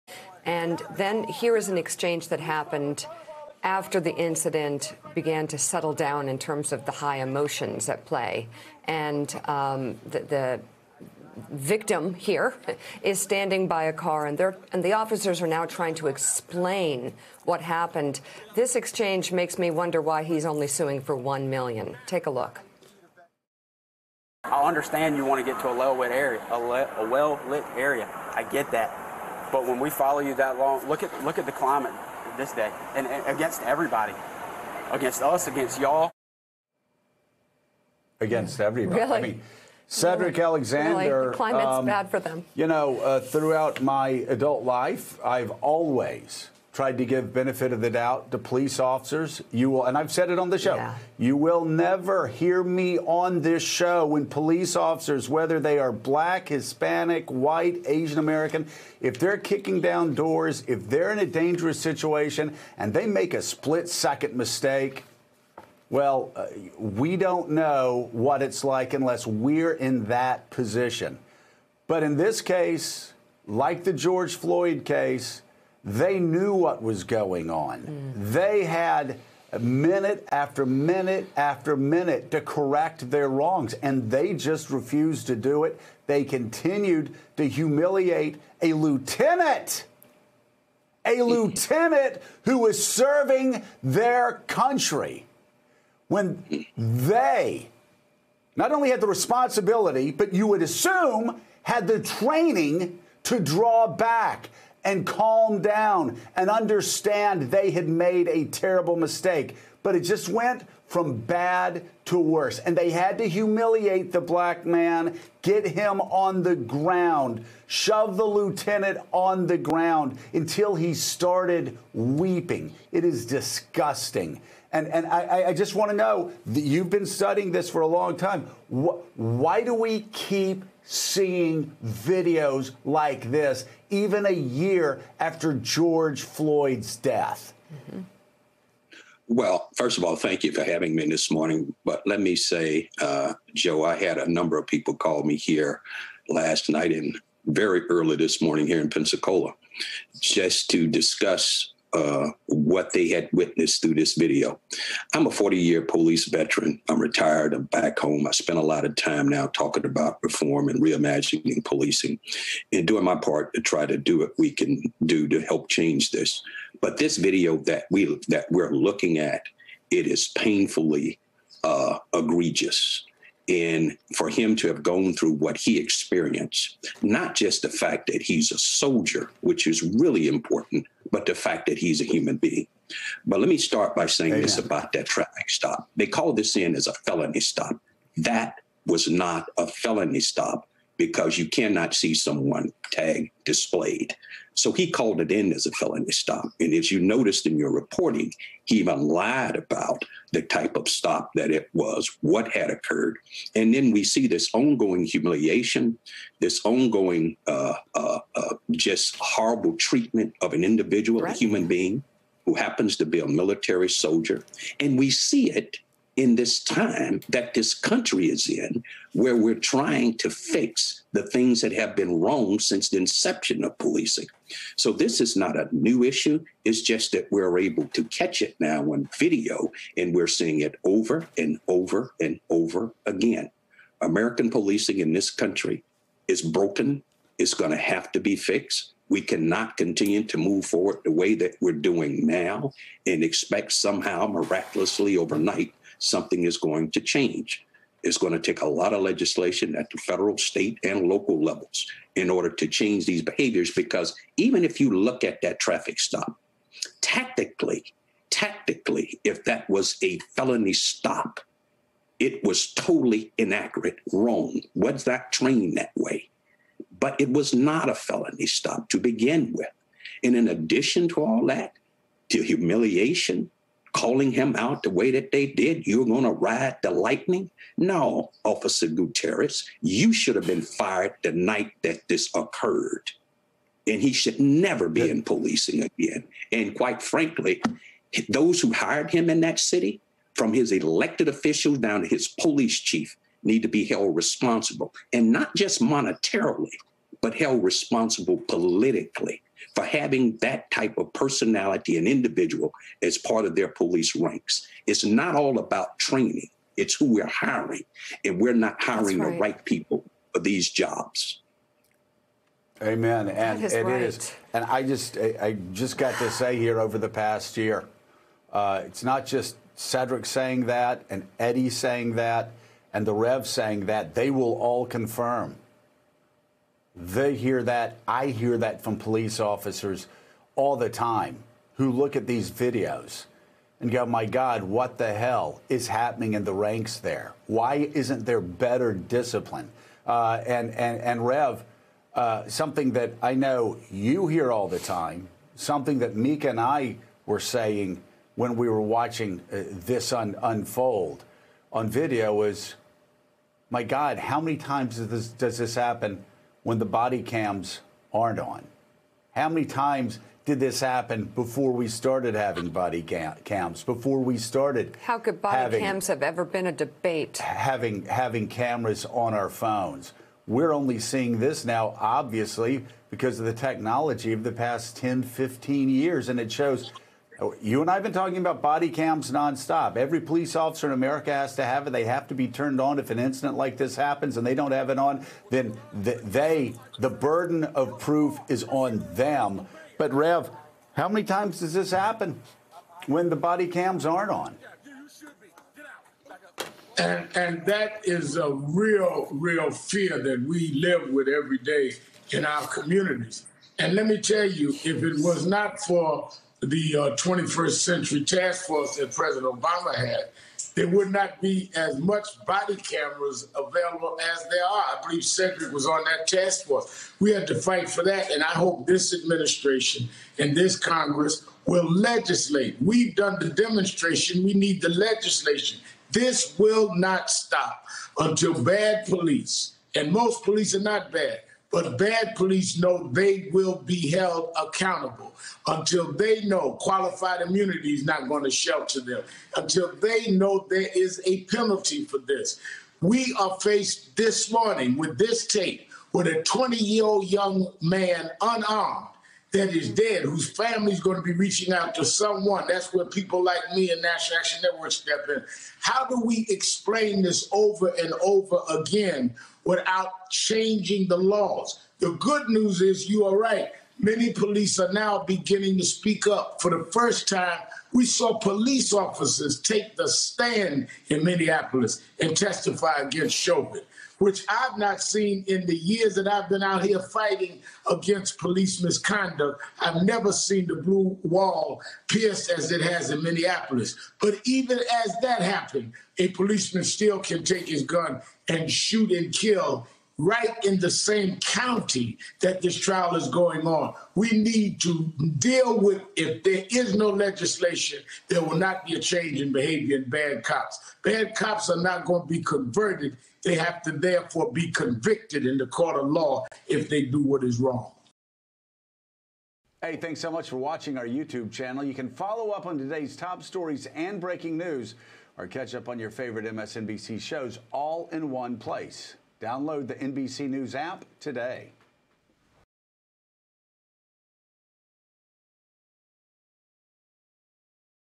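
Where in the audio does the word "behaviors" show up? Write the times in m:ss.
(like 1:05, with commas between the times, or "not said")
4:13, 8:19.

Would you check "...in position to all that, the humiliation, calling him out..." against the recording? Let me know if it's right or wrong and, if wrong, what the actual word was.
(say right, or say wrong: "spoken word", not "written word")
wrong: "addition", not "position".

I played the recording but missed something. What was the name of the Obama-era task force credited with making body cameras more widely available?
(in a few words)
21st Century Task Force.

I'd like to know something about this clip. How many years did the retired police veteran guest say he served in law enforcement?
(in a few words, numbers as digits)
40.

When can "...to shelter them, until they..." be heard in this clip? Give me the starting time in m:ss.
7:18.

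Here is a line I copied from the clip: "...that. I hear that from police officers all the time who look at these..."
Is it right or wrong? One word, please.
right.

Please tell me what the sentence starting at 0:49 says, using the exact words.
You will, and I've said it on the show, yeah.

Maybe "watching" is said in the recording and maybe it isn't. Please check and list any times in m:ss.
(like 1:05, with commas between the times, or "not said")
5:48, 8:30.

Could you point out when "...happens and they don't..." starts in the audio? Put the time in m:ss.
6:23.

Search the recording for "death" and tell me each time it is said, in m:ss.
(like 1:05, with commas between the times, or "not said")
2:16.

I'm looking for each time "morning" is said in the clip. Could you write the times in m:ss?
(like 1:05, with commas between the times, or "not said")
2:21, 2:28, 7:24.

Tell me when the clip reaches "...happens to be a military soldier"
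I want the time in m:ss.
3:32.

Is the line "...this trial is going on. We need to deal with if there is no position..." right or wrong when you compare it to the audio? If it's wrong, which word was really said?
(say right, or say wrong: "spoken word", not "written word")
wrong: "legislation", not "position".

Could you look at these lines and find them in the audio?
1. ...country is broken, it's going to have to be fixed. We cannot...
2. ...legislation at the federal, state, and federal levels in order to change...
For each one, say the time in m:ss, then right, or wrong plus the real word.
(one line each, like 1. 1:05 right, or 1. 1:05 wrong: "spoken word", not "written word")
1. 3:55 right
2. 4:09 wrong: "local", not "federal".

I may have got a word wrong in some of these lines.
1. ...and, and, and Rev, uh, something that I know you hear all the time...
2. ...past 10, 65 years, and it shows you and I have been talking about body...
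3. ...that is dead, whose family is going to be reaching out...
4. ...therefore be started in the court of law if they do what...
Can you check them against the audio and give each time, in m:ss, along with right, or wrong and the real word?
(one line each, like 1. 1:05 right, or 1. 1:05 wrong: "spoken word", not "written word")
1. 5:40 right
2. 6:14 wrong: "15", not "65"
3. 7:29 right
4. 8:23 wrong: "convicted", not "started".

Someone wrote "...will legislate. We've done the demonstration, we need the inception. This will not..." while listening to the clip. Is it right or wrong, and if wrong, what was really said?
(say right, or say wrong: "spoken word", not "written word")
wrong: "legislation", not "inception".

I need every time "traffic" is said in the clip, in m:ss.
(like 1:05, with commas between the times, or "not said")
3:05, 4:15.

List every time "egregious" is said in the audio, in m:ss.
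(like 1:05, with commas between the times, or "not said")
2:52.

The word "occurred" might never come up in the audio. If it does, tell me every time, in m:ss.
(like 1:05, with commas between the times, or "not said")
3:22, 4:42.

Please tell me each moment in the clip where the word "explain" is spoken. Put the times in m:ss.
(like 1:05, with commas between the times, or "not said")
0:16, 7:36.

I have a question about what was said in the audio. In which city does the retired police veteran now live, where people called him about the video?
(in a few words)
Pensacola.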